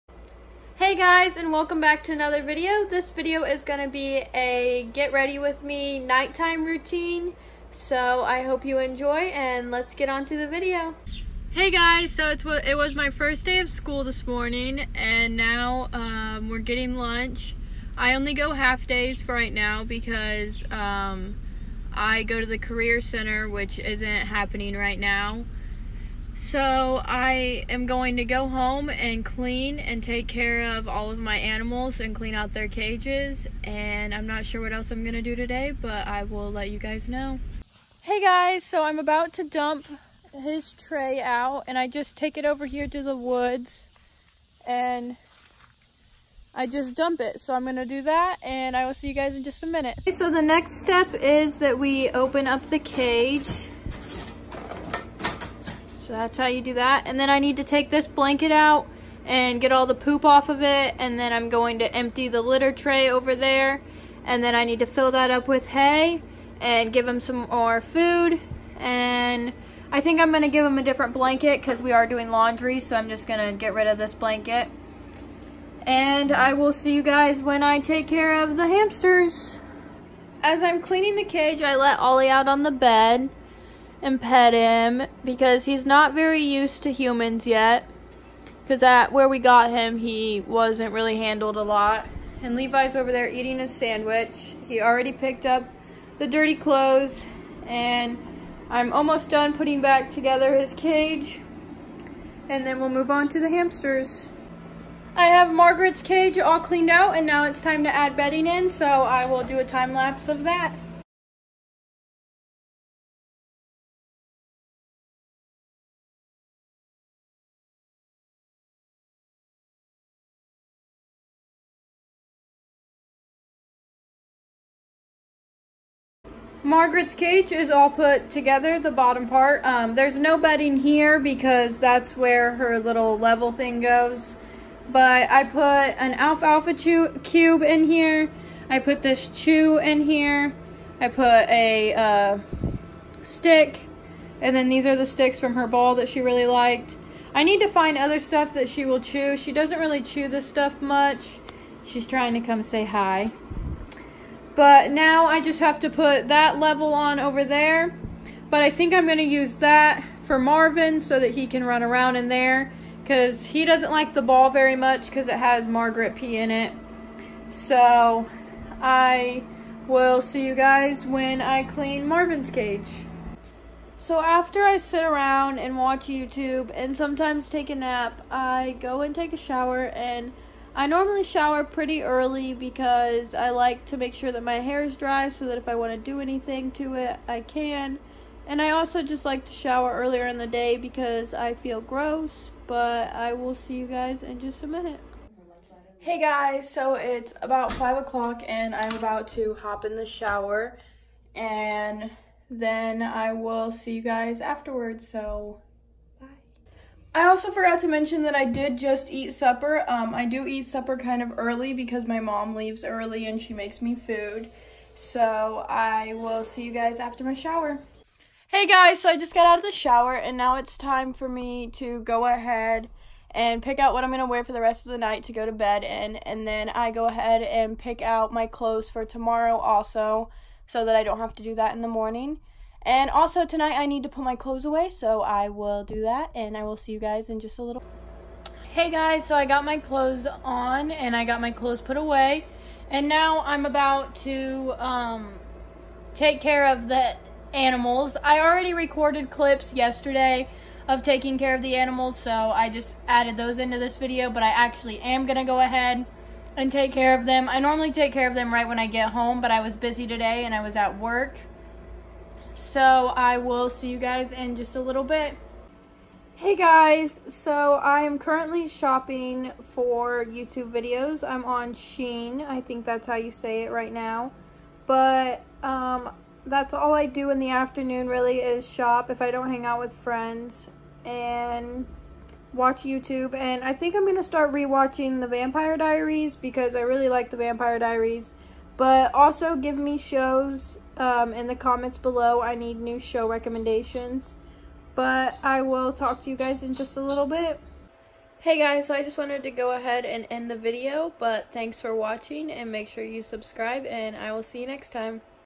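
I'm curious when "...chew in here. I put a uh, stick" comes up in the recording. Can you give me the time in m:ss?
2:19.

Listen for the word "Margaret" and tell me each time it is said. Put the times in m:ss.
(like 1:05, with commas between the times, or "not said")
1:45, 2:06, 2:45.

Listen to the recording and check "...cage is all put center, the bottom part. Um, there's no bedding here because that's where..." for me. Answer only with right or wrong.
wrong.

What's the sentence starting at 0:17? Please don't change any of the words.
I only go half days for right now because um, I go to the career center which isn't happening right now.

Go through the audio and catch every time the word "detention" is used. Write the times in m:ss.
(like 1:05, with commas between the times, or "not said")
not said.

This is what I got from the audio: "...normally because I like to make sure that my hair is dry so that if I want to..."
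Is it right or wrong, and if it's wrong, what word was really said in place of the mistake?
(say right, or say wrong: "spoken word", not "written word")
wrong: "early", not "normally".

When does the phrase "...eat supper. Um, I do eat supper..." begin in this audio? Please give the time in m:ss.
3:29.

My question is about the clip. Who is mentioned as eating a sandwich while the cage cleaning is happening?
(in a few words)
Levi.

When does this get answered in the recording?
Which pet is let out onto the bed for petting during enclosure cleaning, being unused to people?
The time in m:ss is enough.
1:21.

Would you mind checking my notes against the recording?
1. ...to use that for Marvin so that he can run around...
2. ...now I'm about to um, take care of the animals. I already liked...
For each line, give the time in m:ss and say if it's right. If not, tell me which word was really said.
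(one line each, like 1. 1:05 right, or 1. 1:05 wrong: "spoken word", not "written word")
1. 2:39 right
2. 4:03 wrong: "recorded", not "liked".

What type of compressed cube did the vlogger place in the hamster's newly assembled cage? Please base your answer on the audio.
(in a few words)
alfalfa cube.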